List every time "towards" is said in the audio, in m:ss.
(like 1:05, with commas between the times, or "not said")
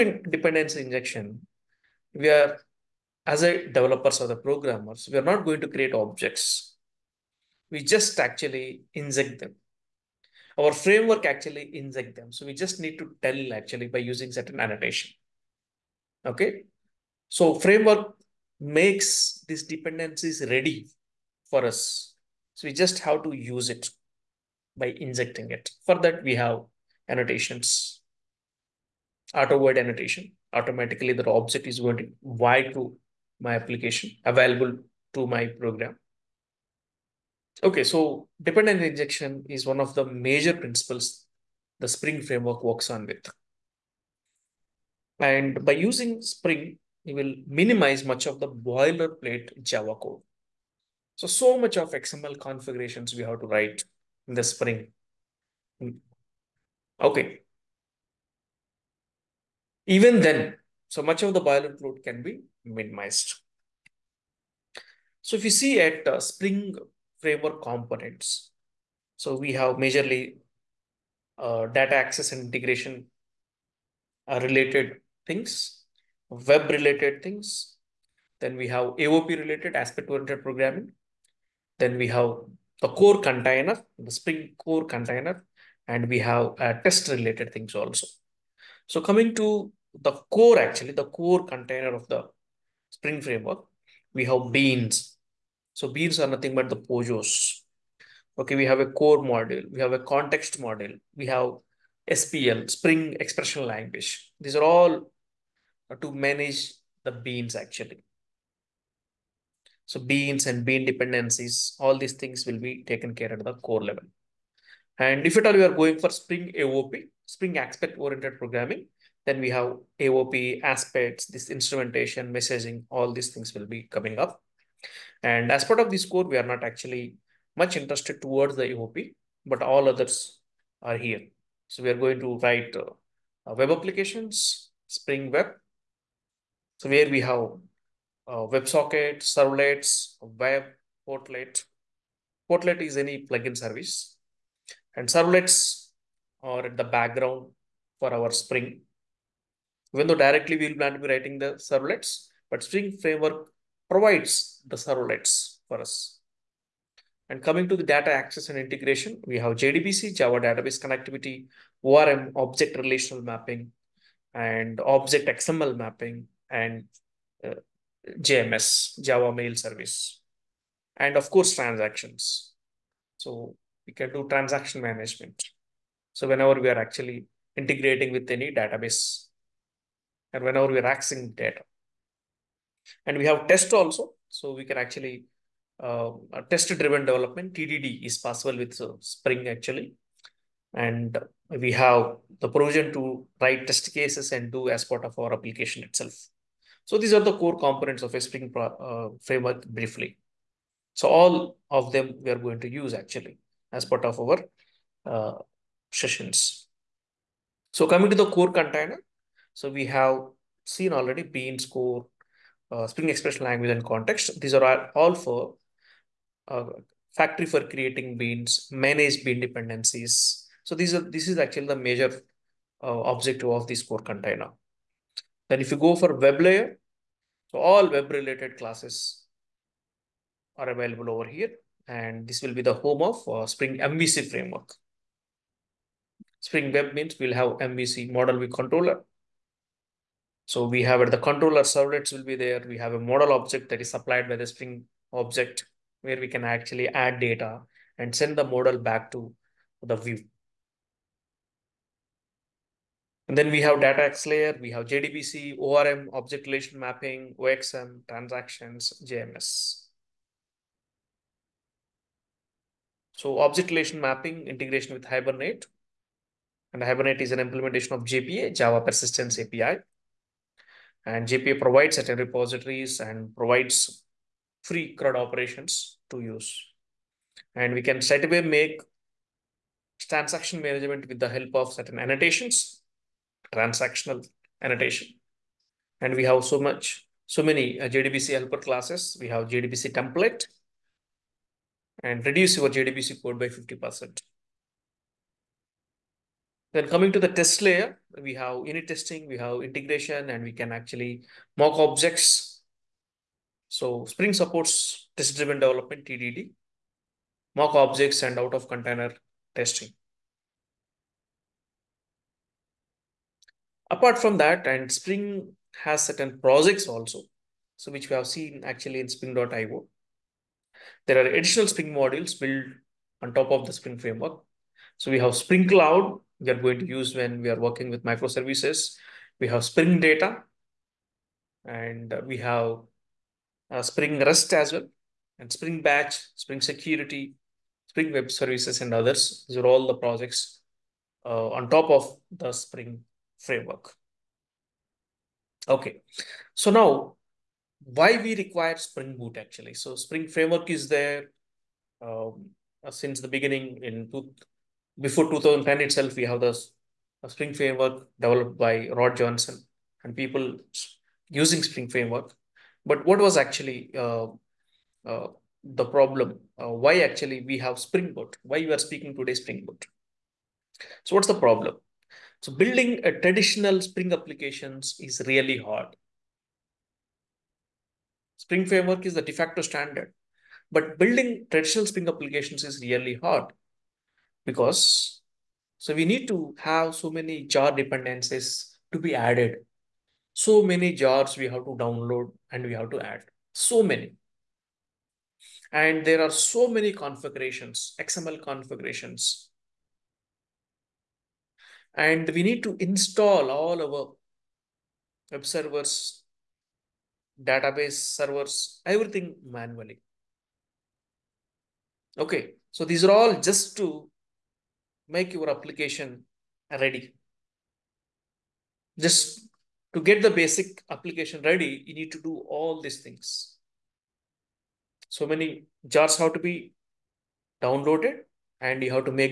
2:08.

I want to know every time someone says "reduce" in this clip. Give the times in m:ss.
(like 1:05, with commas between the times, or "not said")
4:52.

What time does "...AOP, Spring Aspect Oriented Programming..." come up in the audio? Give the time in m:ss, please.
1:56.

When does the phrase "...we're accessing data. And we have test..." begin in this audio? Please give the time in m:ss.
3:00.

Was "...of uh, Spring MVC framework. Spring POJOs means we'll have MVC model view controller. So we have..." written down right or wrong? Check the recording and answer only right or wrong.
wrong.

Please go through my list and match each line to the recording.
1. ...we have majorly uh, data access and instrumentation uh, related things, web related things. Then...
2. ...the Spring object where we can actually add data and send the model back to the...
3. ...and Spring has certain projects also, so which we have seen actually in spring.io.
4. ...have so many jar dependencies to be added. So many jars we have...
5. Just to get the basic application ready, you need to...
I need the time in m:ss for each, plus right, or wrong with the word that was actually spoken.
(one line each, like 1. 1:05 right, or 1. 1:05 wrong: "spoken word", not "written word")
1. 1:09 wrong: "integration", not "instrumentation"
2. 4:04 right
3. 5:14 right
4. 6:26 right
5. 6:58 right.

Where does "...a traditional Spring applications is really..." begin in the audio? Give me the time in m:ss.
6:13.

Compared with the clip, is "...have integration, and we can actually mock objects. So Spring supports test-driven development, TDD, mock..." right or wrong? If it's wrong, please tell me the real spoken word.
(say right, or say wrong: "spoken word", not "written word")
right.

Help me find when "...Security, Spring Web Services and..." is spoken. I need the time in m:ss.
5:36.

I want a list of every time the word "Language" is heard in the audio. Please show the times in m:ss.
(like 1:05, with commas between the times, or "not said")
1:43, 3:33.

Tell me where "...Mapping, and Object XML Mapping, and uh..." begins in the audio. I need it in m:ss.
2:43.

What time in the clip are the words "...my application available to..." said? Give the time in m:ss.
0:33.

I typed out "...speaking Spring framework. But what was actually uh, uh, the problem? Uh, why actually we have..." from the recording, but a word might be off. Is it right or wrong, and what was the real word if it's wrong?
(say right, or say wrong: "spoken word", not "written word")
wrong: "using", not "speaking".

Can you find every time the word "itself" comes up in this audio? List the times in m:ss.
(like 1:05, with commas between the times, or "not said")
3:15, 5:55.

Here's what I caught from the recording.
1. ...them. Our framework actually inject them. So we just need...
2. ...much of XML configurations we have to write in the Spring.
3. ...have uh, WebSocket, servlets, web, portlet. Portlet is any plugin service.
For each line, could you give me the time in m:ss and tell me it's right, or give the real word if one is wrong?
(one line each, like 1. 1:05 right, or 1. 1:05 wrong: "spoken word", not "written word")
1. 0:09 right
2. 0:51 right
3. 2:17 right.